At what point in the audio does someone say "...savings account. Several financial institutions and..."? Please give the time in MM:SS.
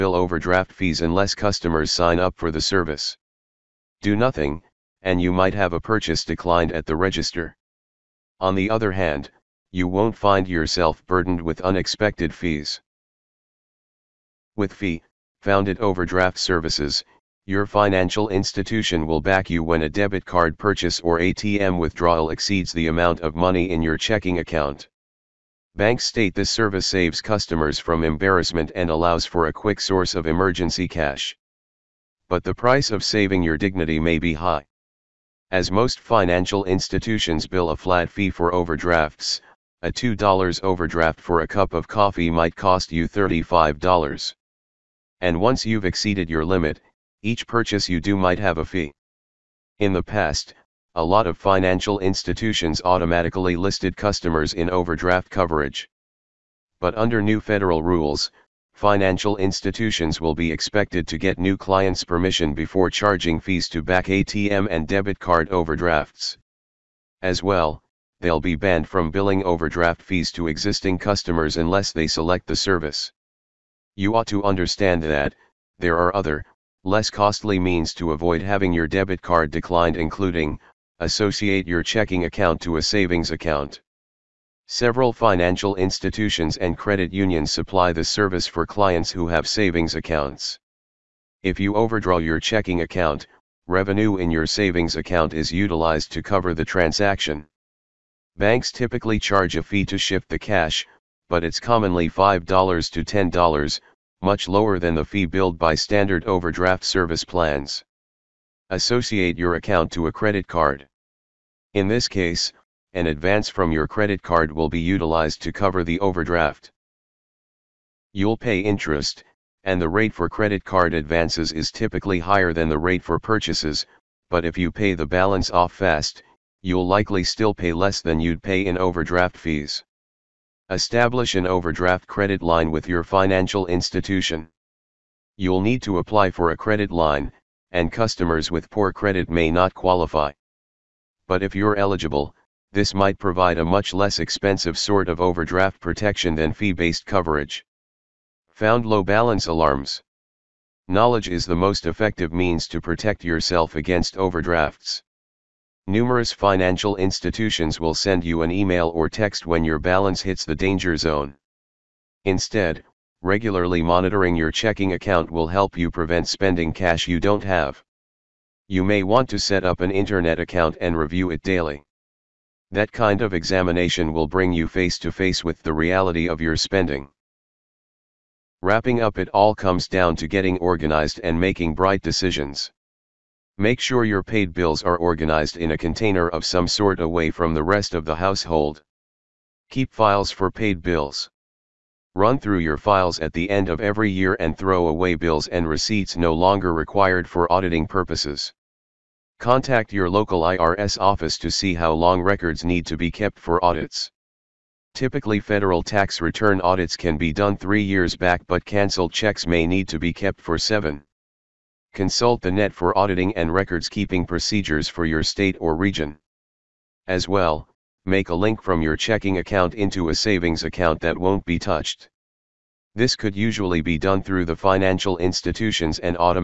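01:22.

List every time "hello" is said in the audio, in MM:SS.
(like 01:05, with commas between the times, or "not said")
not said.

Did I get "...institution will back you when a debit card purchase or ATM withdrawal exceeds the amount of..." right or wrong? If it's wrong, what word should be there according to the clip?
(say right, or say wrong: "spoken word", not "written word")
right.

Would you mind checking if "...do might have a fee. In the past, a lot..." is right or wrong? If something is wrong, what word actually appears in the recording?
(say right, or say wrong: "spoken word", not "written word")
right.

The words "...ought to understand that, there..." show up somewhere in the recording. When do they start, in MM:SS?
01:14.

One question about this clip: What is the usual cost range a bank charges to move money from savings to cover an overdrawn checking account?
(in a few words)
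$5 to $10.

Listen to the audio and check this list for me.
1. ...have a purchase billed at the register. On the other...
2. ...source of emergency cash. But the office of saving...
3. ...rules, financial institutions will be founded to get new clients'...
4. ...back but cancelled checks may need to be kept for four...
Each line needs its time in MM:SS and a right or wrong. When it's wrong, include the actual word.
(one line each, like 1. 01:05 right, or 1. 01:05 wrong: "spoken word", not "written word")
1. 00:05 wrong: "declined", not "billed"
2. 00:29 wrong: "price", not "office"
3. 00:57 wrong: "expected", not "founded"
4. 03:28 wrong: "seven", not "four".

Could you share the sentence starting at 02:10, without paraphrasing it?
Establish an overdraft credit line with your financial institution.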